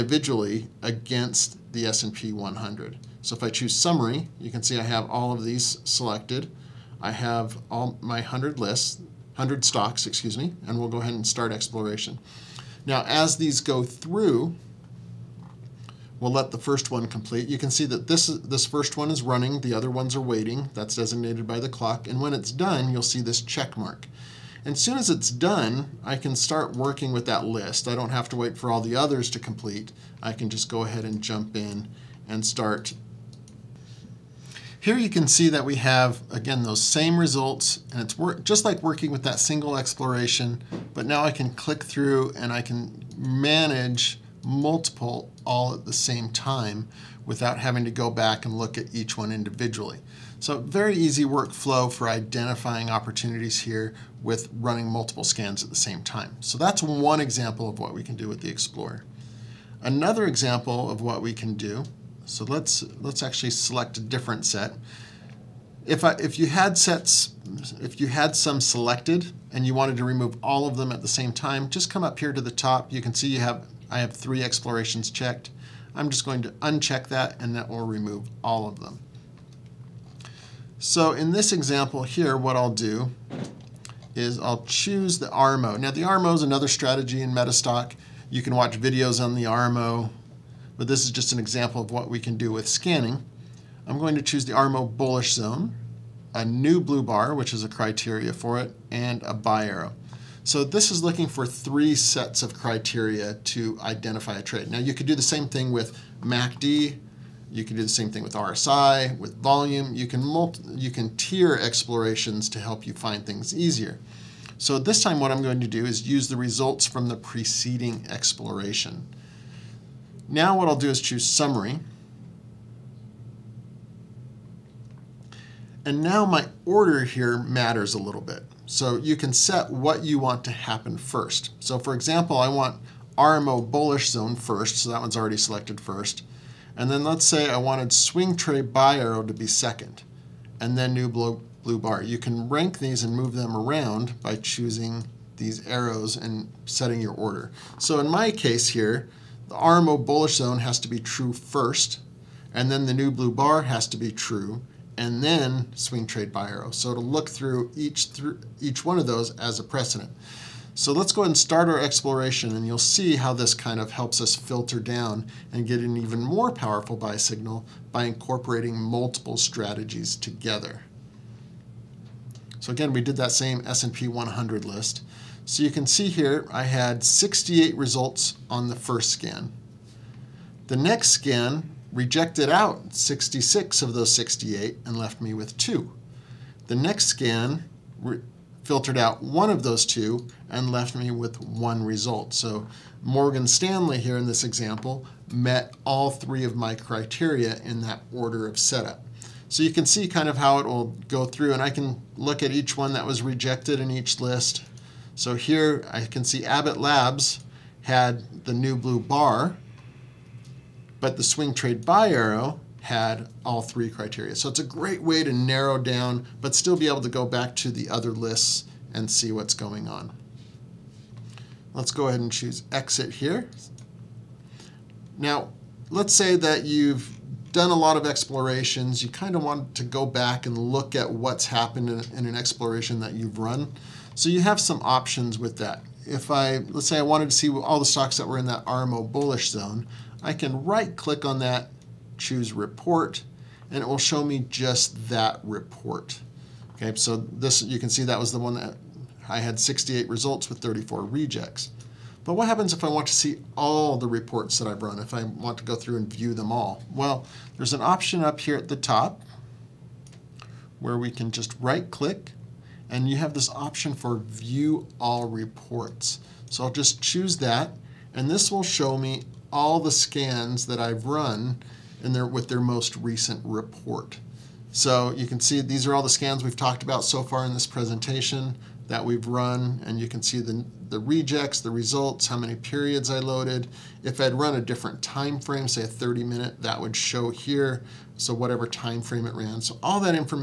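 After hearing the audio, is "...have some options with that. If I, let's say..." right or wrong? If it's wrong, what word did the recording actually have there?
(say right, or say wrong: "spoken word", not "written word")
right.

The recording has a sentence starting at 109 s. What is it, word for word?
You can multi, you can tier explorations to help you find things easier.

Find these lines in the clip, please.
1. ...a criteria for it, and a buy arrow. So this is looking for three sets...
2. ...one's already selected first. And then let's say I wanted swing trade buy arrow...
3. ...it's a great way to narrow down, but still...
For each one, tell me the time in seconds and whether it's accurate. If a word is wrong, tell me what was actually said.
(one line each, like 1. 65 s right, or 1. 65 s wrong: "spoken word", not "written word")
1. 97 s right
2. 134 s right
3. 214 s right.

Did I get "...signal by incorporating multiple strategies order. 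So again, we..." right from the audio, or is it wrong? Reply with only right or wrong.
wrong.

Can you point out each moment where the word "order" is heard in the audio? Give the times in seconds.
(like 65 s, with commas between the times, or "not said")
126 s, 147 s, 198 s.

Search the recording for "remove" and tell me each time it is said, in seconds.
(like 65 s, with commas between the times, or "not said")
70 s, 77 s.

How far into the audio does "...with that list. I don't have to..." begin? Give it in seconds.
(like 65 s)
27 s.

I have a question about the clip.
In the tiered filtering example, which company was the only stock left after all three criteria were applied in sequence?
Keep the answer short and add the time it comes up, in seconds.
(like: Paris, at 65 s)
Morgan Stanley, at 193 s.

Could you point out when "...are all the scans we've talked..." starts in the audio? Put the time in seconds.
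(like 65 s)
275 s.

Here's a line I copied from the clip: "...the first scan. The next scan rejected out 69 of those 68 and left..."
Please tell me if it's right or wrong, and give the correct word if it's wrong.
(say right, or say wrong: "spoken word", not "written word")
wrong: "66", not "69".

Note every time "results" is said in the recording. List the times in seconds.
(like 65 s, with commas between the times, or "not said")
37 s, 116 s, 177 s, 191 s, 250 s, 281 s.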